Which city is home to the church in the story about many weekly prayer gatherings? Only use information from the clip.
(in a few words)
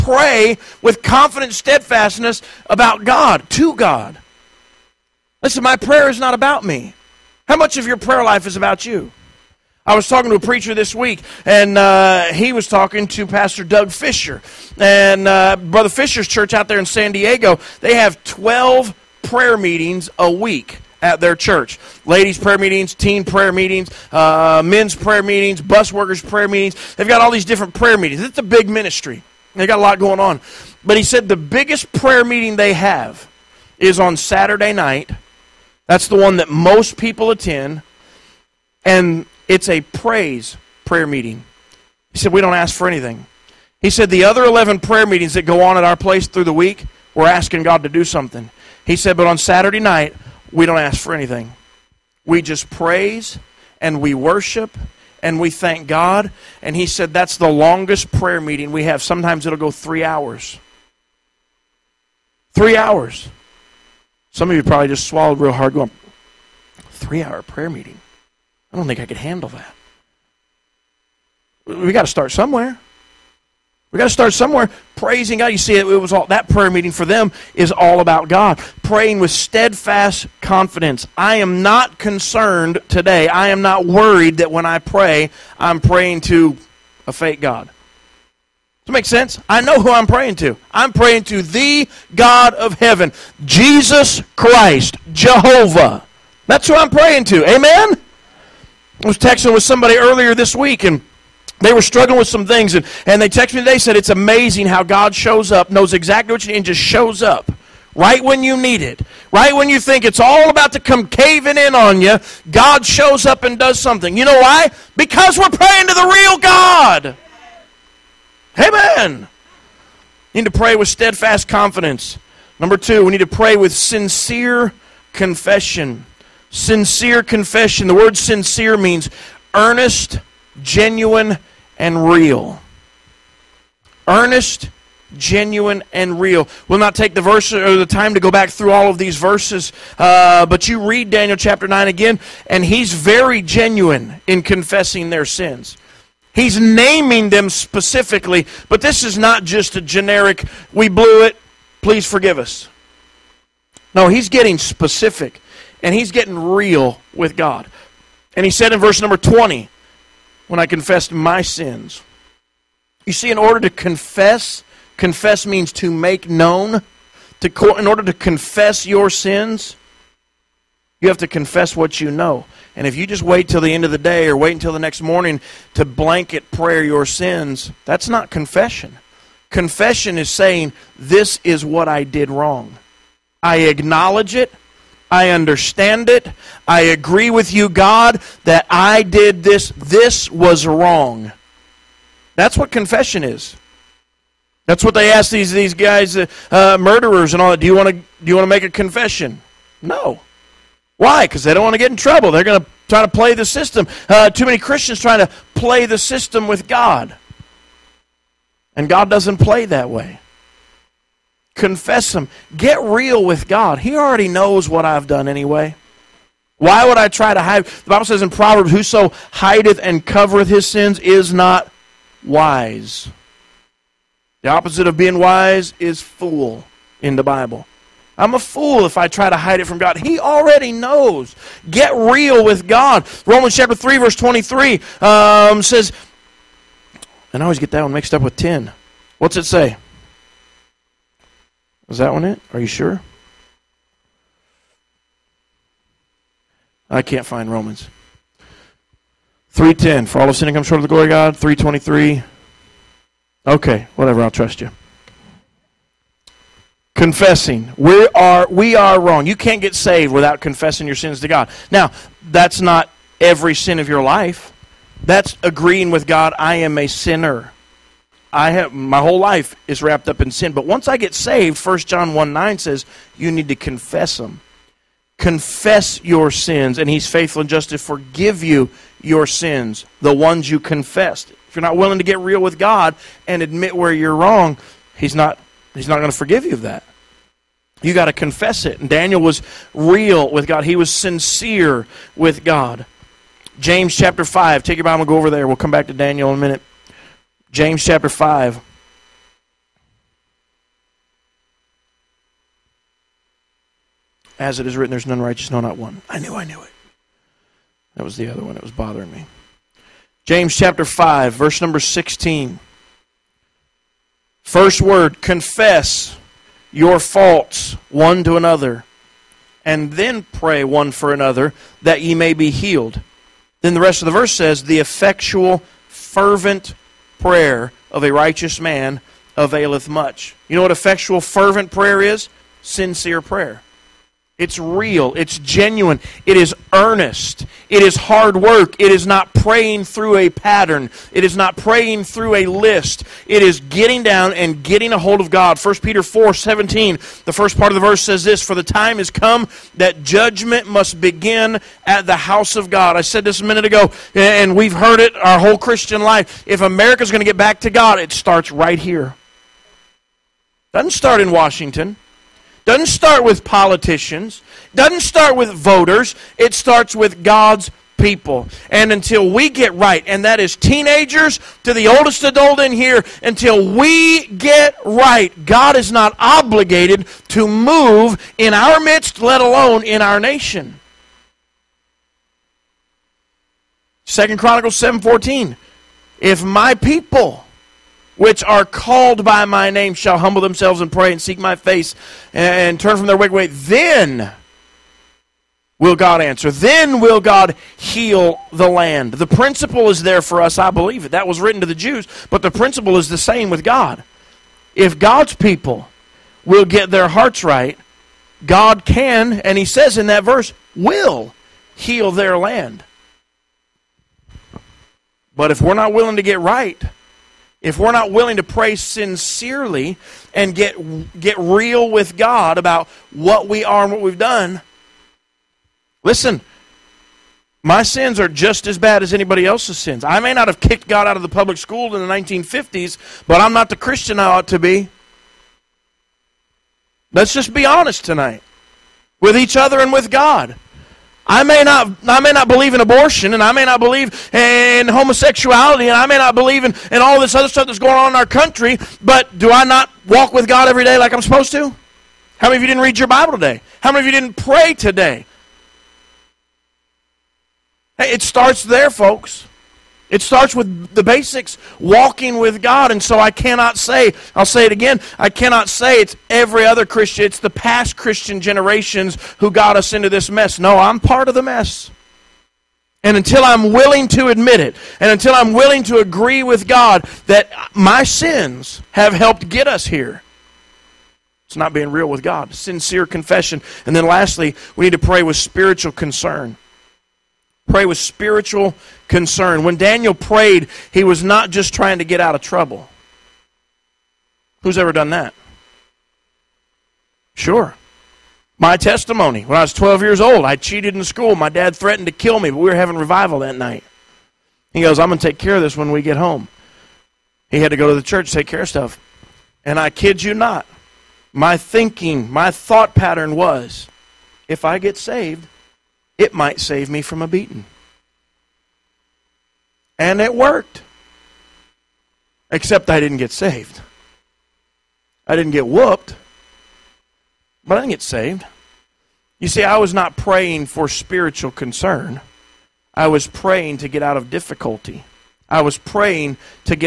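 San Diego.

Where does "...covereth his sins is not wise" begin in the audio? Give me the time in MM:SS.
03:40.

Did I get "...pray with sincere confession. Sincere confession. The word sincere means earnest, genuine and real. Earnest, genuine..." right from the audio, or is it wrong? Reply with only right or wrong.
right.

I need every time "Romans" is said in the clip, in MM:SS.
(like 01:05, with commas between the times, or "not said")
03:53, 04:07.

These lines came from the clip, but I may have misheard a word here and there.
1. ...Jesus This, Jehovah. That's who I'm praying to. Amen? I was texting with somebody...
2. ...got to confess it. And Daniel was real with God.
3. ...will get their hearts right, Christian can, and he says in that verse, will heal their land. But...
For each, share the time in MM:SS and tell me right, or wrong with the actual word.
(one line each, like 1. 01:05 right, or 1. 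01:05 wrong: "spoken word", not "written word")
1. 01:33 wrong: "Christ", not "This"
2. 04:47 right
3. 06:46 wrong: "God", not "Christian".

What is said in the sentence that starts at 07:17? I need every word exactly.
Let's just be honest tonight with each other and with God.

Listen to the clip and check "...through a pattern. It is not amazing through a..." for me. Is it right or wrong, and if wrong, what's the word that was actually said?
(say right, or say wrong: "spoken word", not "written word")
wrong: "praying", not "amazing".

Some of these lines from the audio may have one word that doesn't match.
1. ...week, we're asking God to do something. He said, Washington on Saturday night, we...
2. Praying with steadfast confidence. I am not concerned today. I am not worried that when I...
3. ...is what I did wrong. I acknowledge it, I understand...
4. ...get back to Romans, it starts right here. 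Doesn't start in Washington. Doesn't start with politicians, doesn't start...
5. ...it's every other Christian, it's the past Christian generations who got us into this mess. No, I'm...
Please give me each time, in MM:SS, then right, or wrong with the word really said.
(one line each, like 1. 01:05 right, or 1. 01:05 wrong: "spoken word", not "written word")
1. 00:46 wrong: "But", not "Washington"
2. 01:18 right
3. 03:01 right
4. 05:57 wrong: "God", not "Romans"
5. 07:46 right.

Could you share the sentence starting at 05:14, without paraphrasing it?
First word confess your faults one to another, and then pray one for another that ye may be healed.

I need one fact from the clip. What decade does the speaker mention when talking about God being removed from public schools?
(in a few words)
1950s.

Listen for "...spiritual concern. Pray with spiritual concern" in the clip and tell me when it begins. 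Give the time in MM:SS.
08:05.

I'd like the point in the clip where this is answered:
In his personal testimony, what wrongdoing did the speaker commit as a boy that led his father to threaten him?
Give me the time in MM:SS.
08:20.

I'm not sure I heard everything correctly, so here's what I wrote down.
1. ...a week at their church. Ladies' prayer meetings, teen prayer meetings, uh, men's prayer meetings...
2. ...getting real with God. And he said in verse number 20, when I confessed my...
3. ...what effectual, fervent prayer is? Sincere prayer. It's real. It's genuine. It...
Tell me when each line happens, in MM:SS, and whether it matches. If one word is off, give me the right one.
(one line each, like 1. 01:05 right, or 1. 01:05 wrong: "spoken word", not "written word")
1. 00:20 right
2. 02:36 right
3. 05:30 right.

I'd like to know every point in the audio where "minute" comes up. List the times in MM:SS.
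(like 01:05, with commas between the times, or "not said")
04:56, 05:53.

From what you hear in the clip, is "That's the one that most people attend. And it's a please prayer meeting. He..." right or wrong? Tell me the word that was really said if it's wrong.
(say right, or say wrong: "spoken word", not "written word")
wrong: "praise", not "please".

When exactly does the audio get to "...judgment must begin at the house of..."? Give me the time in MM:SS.
05:50.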